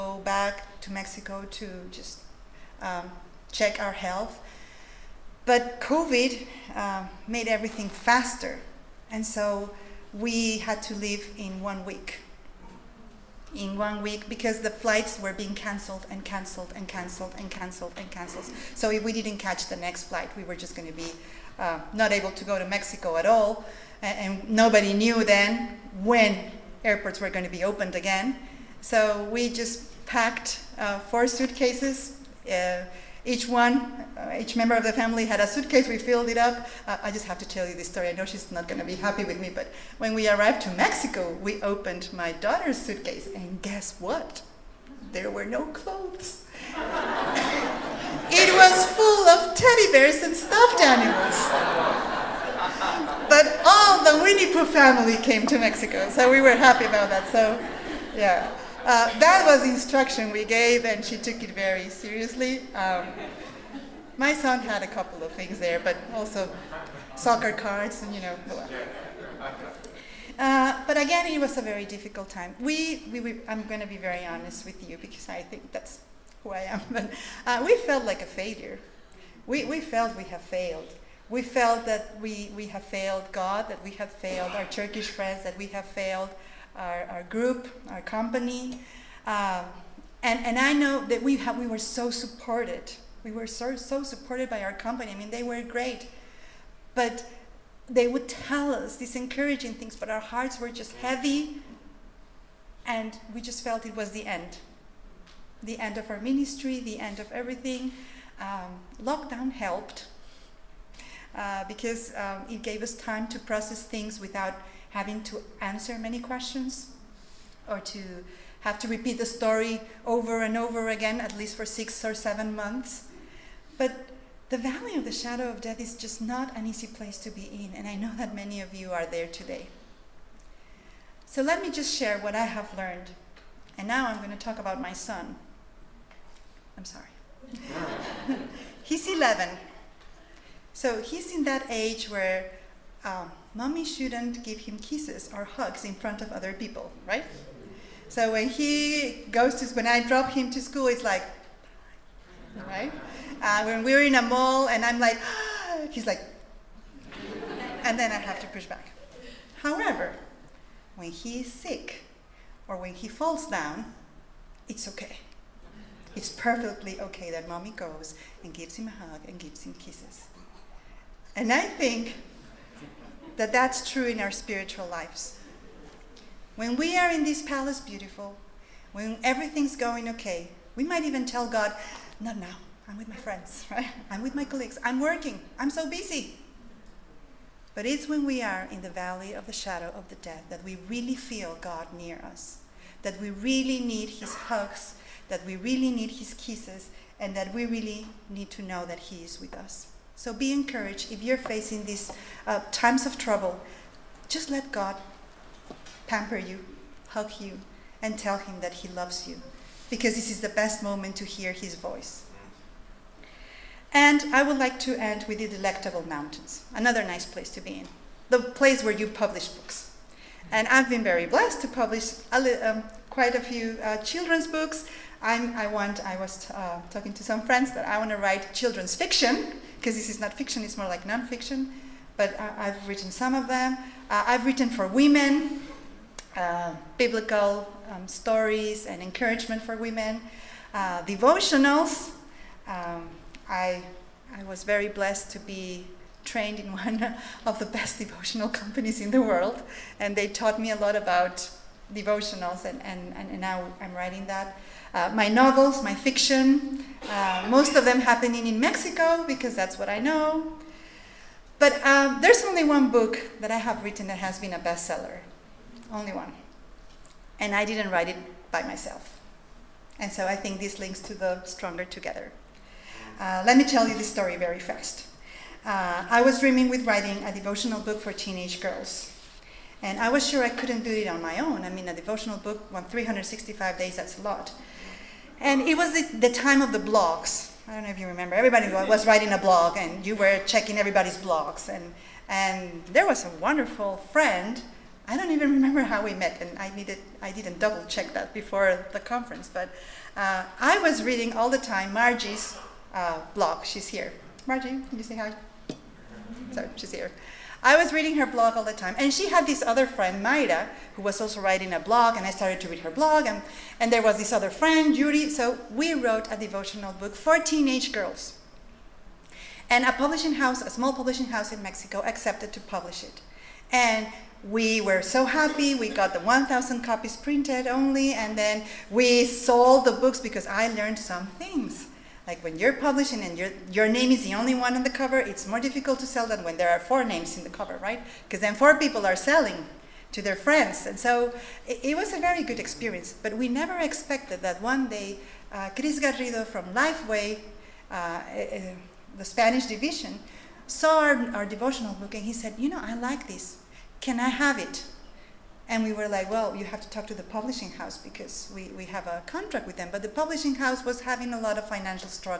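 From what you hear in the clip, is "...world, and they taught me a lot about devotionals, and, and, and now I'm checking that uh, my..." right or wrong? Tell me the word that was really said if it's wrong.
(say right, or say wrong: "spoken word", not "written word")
wrong: "writing", not "checking".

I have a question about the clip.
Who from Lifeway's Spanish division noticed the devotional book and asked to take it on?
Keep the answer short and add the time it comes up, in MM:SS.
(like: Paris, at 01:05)
Chris Garrido, at 05:45.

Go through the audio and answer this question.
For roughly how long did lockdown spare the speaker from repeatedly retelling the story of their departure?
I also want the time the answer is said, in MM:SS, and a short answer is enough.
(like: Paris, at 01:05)
Six or seven months, at 02:01.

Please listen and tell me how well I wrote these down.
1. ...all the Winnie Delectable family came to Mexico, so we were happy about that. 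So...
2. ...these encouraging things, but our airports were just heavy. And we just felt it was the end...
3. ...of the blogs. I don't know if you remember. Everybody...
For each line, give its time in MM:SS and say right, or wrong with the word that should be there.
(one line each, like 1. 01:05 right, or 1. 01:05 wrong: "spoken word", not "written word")
1. 00:53 wrong: "Pooh", not "Delectable"
2. 01:38 wrong: "hearts", not "airports"
3. 04:46 right.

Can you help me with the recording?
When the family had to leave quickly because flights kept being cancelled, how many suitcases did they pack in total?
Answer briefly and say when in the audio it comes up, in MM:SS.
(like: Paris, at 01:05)
4, at 00:30.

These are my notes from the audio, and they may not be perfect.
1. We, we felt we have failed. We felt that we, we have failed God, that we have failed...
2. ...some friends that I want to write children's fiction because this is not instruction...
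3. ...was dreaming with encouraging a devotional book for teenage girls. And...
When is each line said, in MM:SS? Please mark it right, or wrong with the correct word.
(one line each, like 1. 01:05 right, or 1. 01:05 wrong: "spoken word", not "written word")
1. 01:19 right
2. 03:47 wrong: "fiction", not "instruction"
3. 04:36 wrong: "writing", not "encouraging".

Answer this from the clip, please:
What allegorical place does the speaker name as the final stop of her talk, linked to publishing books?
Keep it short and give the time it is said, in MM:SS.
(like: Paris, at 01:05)
Delectable Mountains, at 03:35.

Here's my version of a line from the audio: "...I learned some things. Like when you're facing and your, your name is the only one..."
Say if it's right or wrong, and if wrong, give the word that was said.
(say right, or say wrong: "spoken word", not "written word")
wrong: "publishing", not "facing".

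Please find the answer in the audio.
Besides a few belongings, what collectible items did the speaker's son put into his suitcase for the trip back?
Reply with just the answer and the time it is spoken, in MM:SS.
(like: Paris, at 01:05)
Soccer cards, at 01:07.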